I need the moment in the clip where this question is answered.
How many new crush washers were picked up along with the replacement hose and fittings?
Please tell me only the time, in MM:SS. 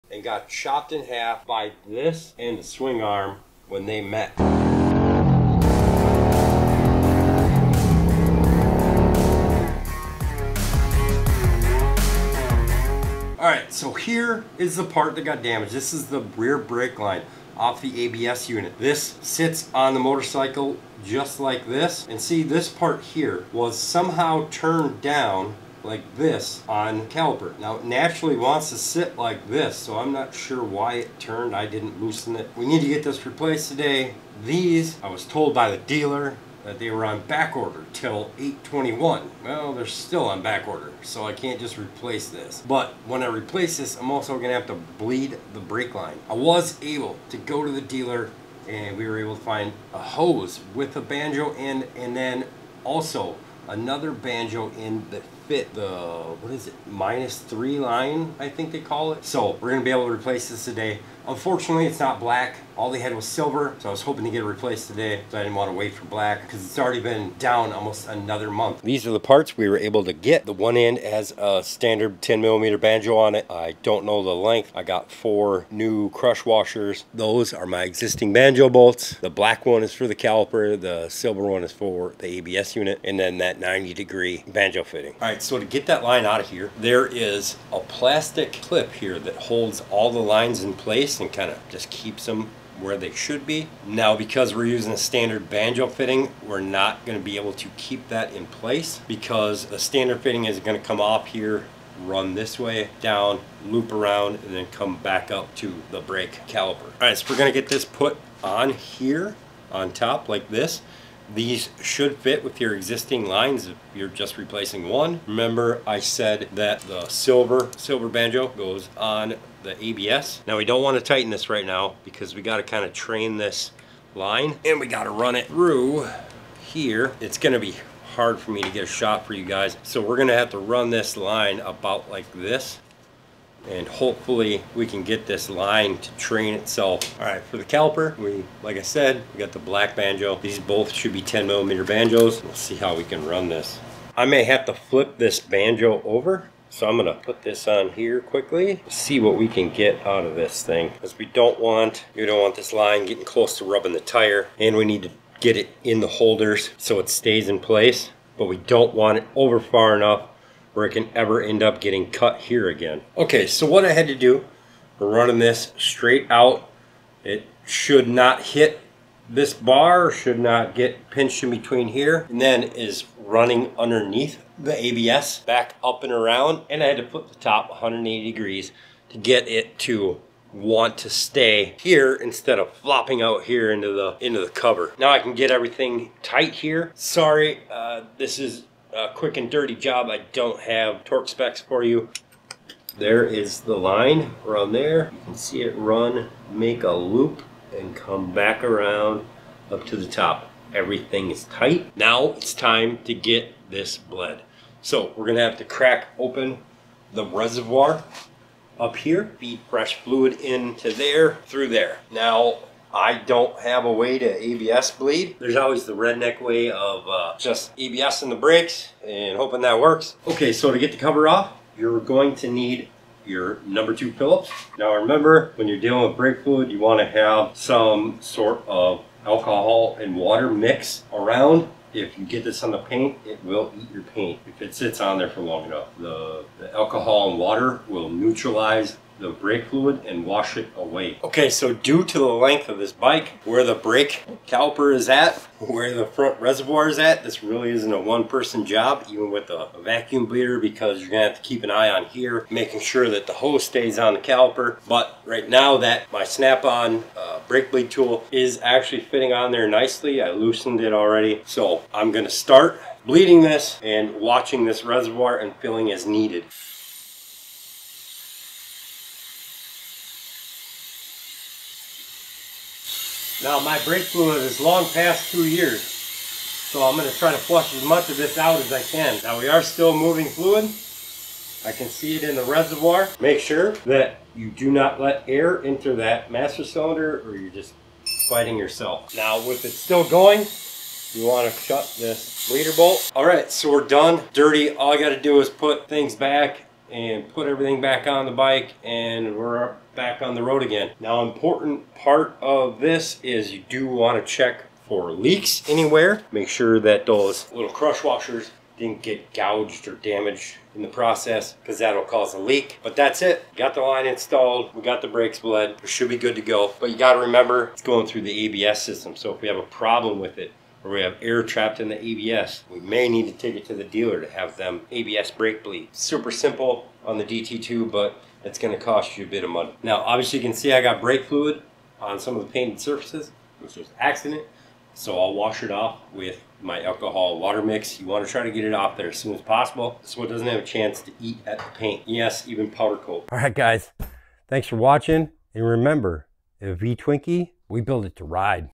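01:14.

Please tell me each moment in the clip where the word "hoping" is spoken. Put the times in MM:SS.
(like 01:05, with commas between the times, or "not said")
01:04, 03:39.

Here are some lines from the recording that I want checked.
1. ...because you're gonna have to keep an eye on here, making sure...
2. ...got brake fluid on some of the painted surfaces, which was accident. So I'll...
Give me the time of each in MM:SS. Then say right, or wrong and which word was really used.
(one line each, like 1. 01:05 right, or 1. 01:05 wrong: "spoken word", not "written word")
1. 04:10 right
2. 05:30 right.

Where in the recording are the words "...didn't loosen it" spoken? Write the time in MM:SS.
00:31.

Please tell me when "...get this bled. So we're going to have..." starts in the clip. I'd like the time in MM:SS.
03:23.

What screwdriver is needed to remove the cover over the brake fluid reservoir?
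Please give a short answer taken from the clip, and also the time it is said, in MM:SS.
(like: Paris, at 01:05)
Number two Phillips, at 03:43.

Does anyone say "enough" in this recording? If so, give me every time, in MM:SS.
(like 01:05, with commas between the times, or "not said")
02:39, 03:55.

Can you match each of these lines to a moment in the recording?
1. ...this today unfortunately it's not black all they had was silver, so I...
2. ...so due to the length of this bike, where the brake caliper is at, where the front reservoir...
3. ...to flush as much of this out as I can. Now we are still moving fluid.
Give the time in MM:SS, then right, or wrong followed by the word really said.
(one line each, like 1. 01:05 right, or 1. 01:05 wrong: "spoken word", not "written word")
1. 01:00 right
2. 04:01 right
3. 04:37 right.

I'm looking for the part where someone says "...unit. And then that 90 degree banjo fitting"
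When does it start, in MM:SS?
01:22.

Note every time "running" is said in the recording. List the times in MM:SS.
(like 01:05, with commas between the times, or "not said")
02:45, 02:53.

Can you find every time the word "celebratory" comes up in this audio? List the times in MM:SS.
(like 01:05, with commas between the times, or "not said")
not said.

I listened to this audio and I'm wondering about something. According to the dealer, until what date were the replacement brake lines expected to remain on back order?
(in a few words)
8/21.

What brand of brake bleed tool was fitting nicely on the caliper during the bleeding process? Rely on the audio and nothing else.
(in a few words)
Snap-on.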